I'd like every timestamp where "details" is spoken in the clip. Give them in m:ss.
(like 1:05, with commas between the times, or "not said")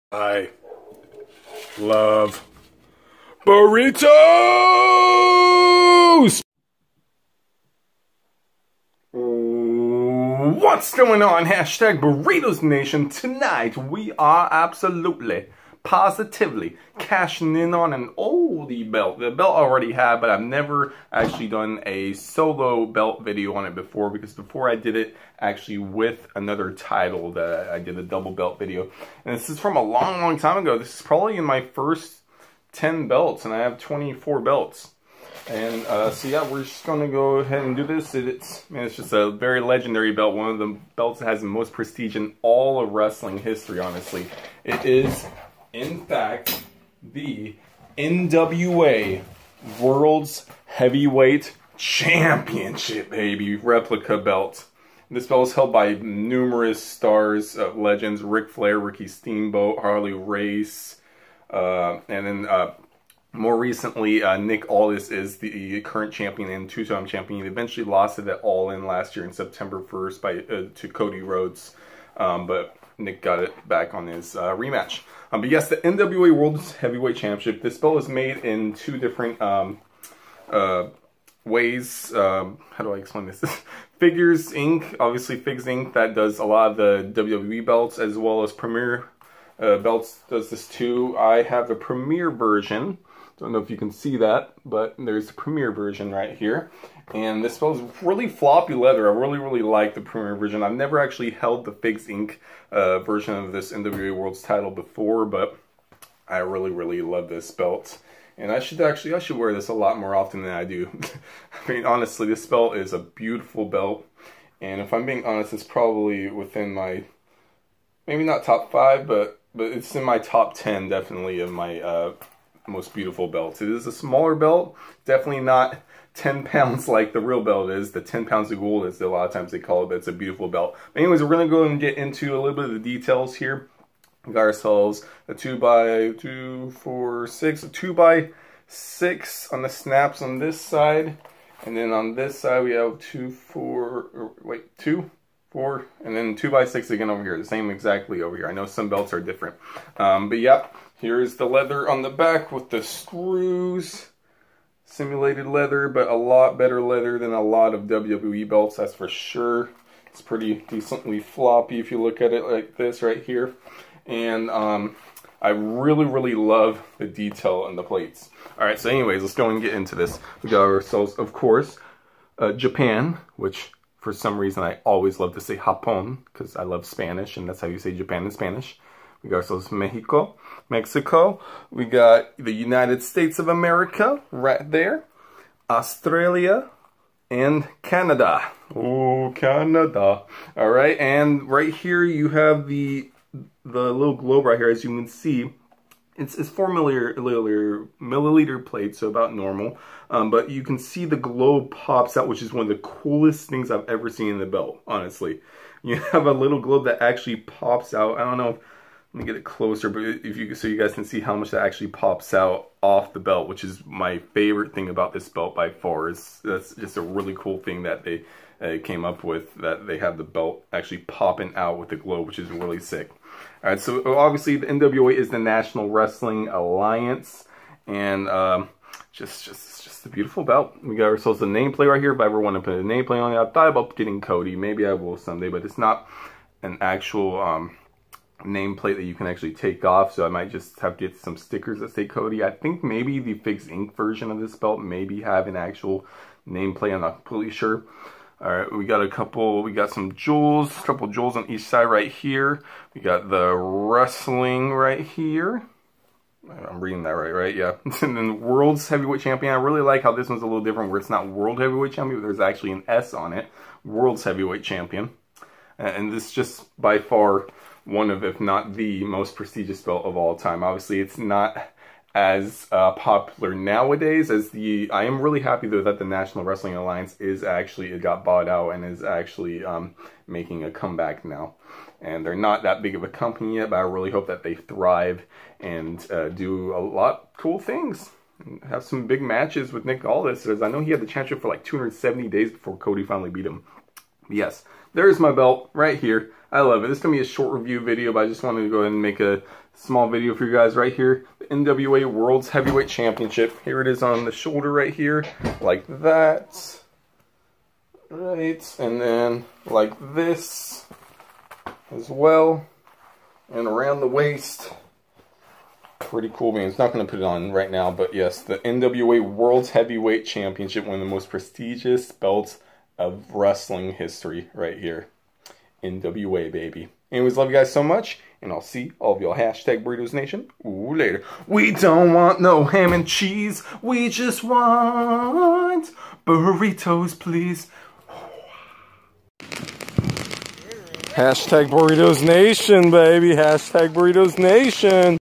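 2:12, 2:47.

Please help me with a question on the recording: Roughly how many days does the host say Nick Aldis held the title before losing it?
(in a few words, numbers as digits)
270.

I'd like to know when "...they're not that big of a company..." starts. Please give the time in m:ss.
4:42.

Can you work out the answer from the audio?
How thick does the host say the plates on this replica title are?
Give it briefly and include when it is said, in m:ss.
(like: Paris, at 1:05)
4 millimeters, at 3:16.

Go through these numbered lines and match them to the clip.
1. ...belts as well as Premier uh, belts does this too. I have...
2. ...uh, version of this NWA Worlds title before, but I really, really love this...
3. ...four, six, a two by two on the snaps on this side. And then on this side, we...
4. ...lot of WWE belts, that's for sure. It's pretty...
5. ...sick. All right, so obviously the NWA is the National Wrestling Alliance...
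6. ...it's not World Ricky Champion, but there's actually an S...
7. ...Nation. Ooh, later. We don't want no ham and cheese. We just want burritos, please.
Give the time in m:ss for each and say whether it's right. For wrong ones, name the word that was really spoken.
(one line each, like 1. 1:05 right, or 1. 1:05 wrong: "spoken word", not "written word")
1. 1:27 right
2. 1:42 right
3. 2:16 wrong: "six", not "two"
4. 2:37 right
5. 3:42 right
6. 4:20 wrong: "Heavyweight", not "Ricky"
7. 5:30 right.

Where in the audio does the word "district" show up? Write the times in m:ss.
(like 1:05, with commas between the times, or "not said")
not said.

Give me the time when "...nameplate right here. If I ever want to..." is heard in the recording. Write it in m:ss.
3:51.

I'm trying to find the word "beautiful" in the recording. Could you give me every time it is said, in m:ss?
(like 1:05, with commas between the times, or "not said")
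1:52, 2:02, 2:10, 3:50.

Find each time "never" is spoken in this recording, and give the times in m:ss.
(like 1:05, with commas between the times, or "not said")
0:20, 1:40.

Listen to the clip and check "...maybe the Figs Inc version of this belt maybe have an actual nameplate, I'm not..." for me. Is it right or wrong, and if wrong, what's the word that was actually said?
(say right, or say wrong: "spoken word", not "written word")
right.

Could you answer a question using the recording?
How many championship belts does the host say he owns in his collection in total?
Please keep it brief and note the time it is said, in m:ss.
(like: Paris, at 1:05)
24, at 0:33.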